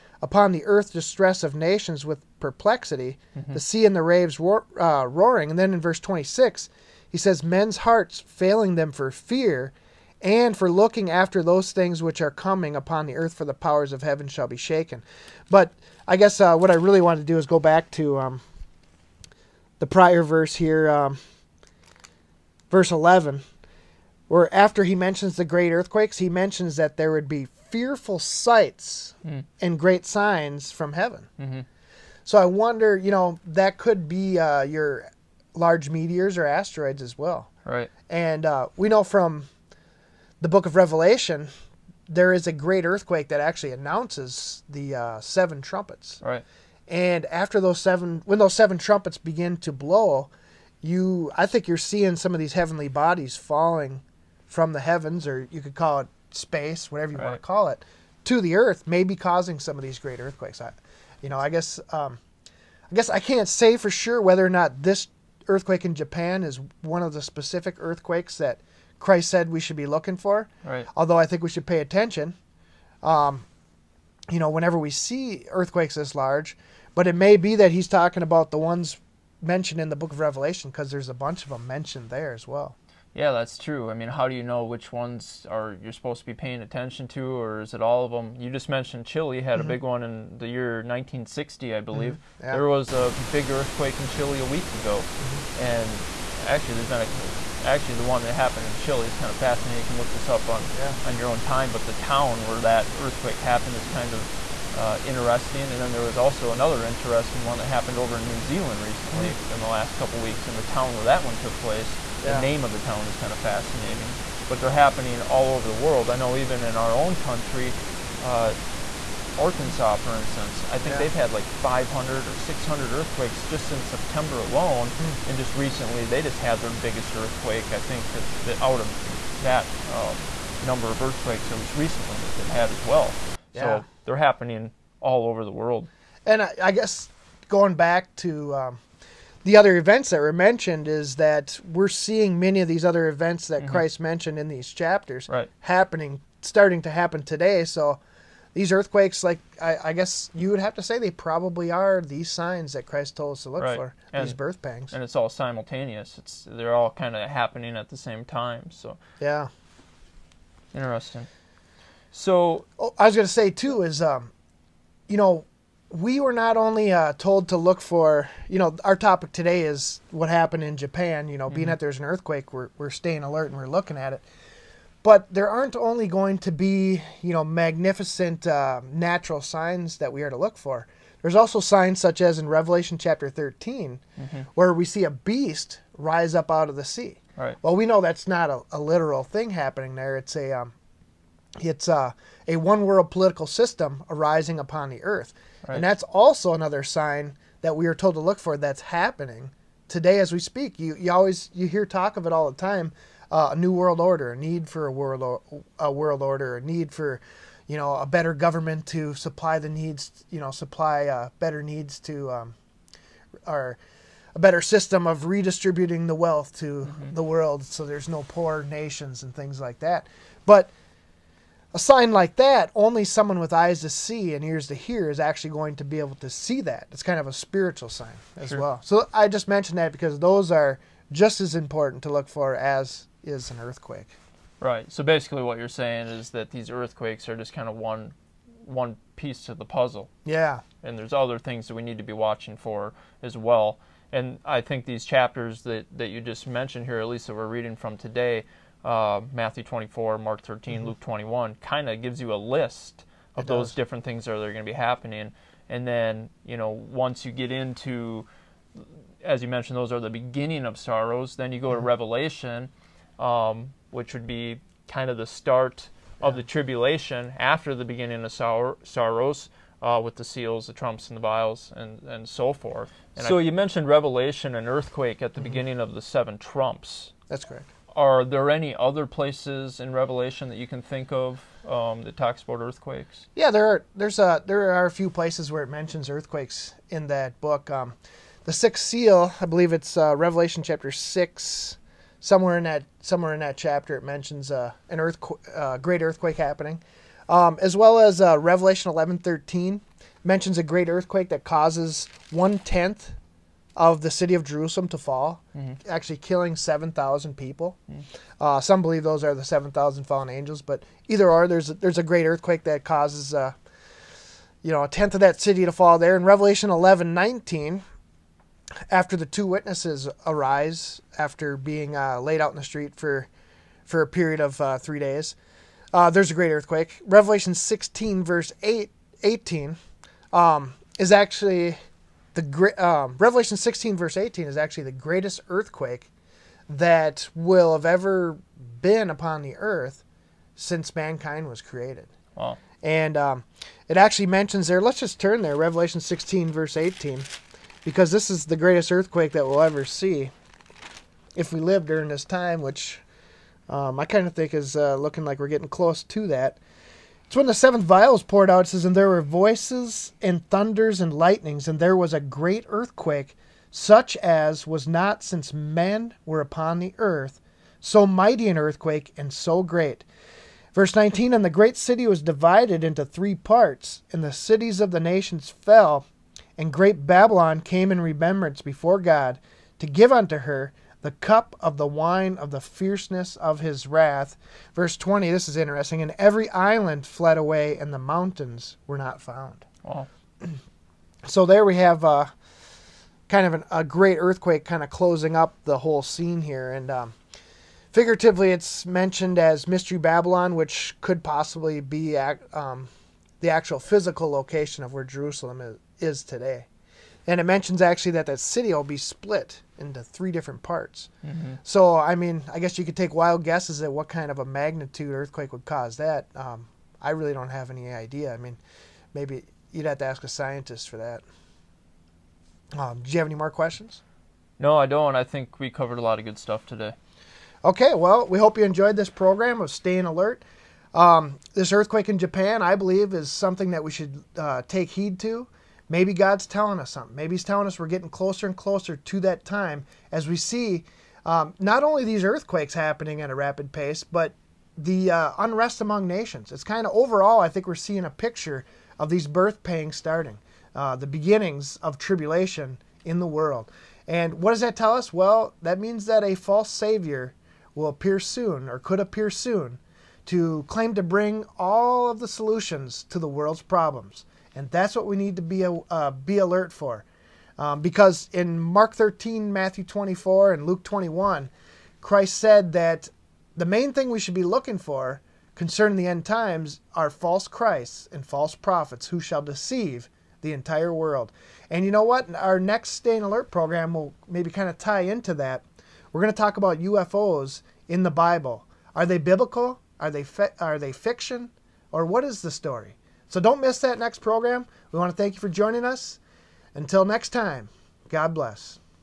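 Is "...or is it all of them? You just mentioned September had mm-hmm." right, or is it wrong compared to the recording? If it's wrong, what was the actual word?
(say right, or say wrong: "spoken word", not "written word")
wrong: "Chile", not "September".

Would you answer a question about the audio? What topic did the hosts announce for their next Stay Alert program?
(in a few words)
UFOs in the Bible.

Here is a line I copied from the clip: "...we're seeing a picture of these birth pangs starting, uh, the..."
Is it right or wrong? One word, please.
right.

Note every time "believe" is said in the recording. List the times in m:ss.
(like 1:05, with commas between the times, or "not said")
1:31, 4:49, 5:08, 7:12.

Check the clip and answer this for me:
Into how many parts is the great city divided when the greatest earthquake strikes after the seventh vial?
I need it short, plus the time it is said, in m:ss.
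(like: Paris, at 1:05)
3, at 6:13.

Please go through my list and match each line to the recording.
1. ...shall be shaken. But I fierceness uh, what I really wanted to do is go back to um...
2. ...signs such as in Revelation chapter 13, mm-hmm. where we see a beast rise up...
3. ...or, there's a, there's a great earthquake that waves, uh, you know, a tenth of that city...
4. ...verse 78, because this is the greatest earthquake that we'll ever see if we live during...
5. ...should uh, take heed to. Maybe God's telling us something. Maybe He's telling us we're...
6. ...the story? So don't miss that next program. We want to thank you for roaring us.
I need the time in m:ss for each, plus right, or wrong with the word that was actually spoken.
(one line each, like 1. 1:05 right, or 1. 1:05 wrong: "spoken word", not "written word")
1. 0:14 wrong: "guess", not "fierceness"
2. 3:01 right
3. 5:11 wrong: "causes", not "waves"
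4. 5:46 wrong: "18", not "78"
5. 7:13 right
6. 8:12 wrong: "joining", not "roaring".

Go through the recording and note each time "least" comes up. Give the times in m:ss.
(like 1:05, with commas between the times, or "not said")
2:11, 4:07.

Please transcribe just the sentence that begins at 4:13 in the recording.
different things that are, are going to be happening.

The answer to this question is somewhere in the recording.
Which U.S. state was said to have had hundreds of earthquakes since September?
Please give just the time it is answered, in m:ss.
1:59.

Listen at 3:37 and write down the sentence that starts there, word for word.
the world so there's no poor nations and things like that.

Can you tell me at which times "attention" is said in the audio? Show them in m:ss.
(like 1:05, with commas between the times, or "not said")
1:11, 1:26.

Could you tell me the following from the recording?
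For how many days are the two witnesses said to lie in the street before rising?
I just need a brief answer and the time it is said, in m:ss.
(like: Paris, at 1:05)
3, at 5:24.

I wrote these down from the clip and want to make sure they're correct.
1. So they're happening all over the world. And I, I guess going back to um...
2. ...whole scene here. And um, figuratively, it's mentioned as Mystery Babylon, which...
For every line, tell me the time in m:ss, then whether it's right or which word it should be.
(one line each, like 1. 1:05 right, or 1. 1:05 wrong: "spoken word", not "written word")
1. 2:13 right
2. 6:35 right.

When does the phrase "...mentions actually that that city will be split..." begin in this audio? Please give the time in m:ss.
6:47.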